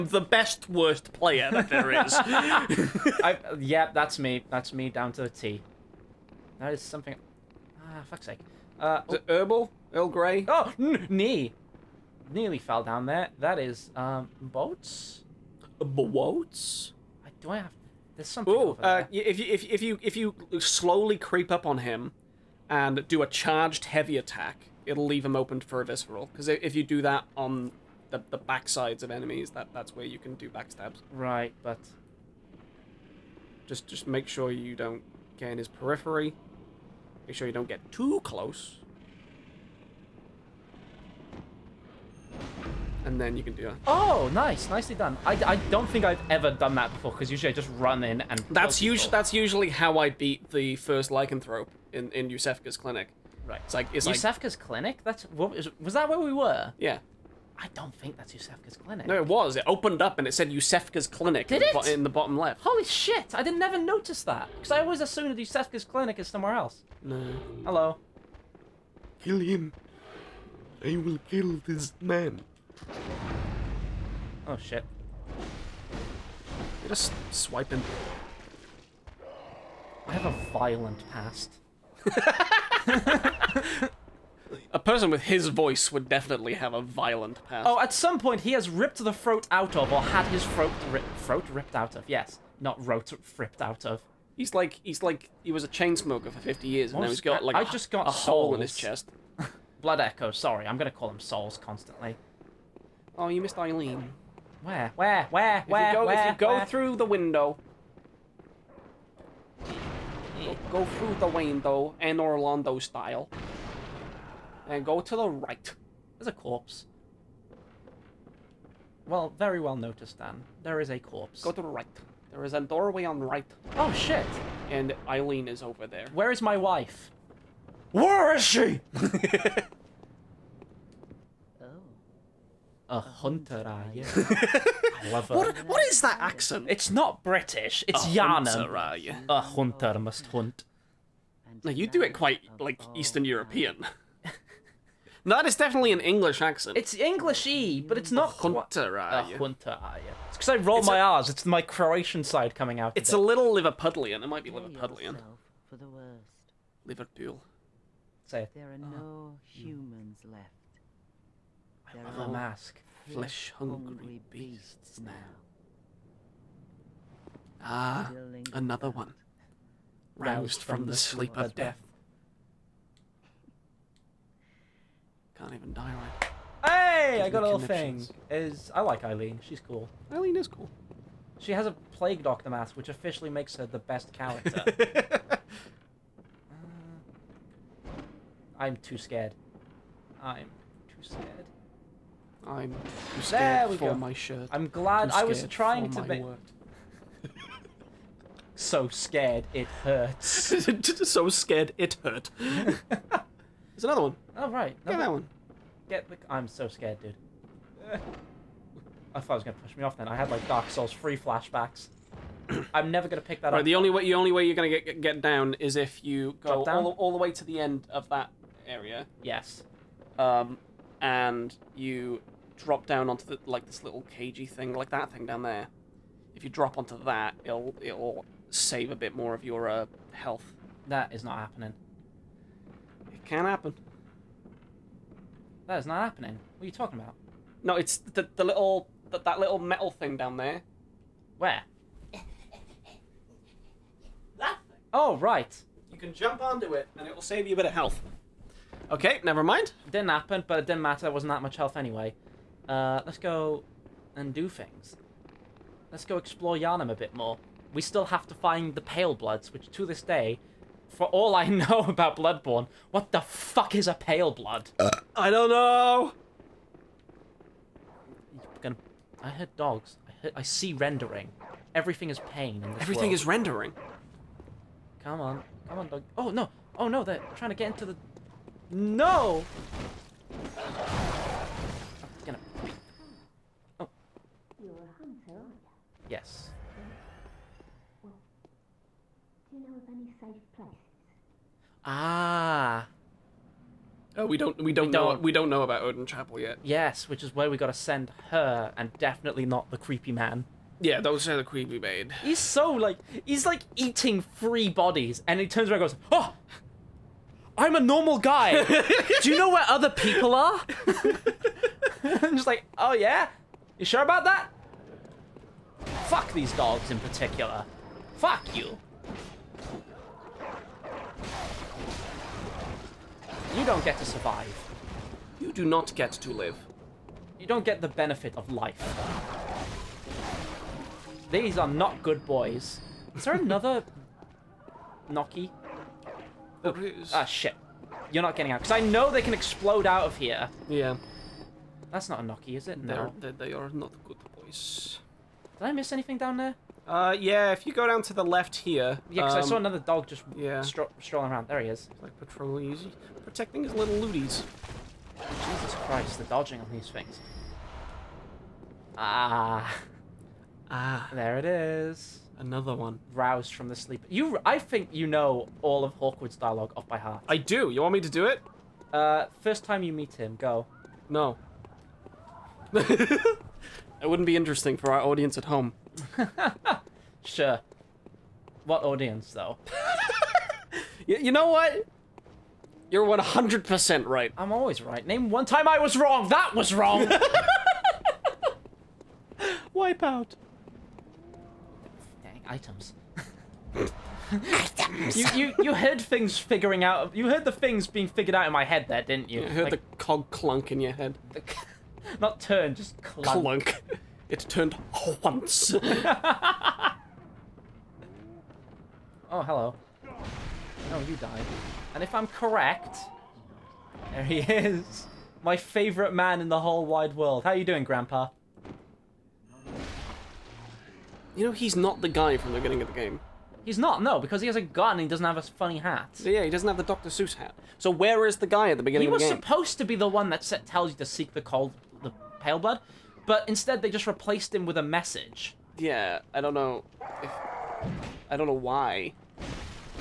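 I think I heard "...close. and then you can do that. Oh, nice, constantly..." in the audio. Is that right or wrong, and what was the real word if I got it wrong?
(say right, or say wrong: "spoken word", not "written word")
wrong: "nicely", not "constantly".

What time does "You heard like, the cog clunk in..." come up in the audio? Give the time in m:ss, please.
6:39.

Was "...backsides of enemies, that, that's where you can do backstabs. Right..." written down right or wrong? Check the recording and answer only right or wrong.
right.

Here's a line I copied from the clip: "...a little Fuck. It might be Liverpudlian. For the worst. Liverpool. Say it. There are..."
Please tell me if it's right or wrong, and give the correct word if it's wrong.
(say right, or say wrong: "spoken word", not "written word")
wrong: "Liverpudlian", not "Fuck".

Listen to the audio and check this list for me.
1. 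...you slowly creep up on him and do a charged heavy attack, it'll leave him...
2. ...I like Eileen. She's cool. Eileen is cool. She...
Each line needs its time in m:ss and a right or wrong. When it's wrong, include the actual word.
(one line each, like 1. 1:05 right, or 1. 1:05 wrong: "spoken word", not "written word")
1. 0:20 right
2. 2:58 right.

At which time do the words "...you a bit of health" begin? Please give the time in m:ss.
4:07.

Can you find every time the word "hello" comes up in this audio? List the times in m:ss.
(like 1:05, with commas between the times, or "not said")
1:07, 6:49.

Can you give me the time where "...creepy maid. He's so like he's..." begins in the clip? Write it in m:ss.
5:01.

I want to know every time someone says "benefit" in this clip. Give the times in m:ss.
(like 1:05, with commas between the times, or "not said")
5:27.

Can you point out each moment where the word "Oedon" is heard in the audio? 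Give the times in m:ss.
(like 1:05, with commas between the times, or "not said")
4:55.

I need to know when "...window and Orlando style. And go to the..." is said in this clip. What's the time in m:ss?
1:51.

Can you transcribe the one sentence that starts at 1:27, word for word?
Oh, at some point he has ripped the throat out of, or had his throat ri throat ripped out of.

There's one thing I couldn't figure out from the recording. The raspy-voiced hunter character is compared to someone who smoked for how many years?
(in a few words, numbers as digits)
50.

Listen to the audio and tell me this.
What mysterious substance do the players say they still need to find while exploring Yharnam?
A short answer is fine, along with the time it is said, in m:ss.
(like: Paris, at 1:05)
Pale Blood, at 4:18.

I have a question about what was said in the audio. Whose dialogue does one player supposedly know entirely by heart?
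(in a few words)
Hawkwood.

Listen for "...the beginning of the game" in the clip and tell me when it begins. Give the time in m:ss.
7:02.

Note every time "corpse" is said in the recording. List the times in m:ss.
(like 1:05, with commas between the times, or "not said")
1:56, 2:00.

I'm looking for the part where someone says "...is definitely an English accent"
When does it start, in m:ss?
2:25.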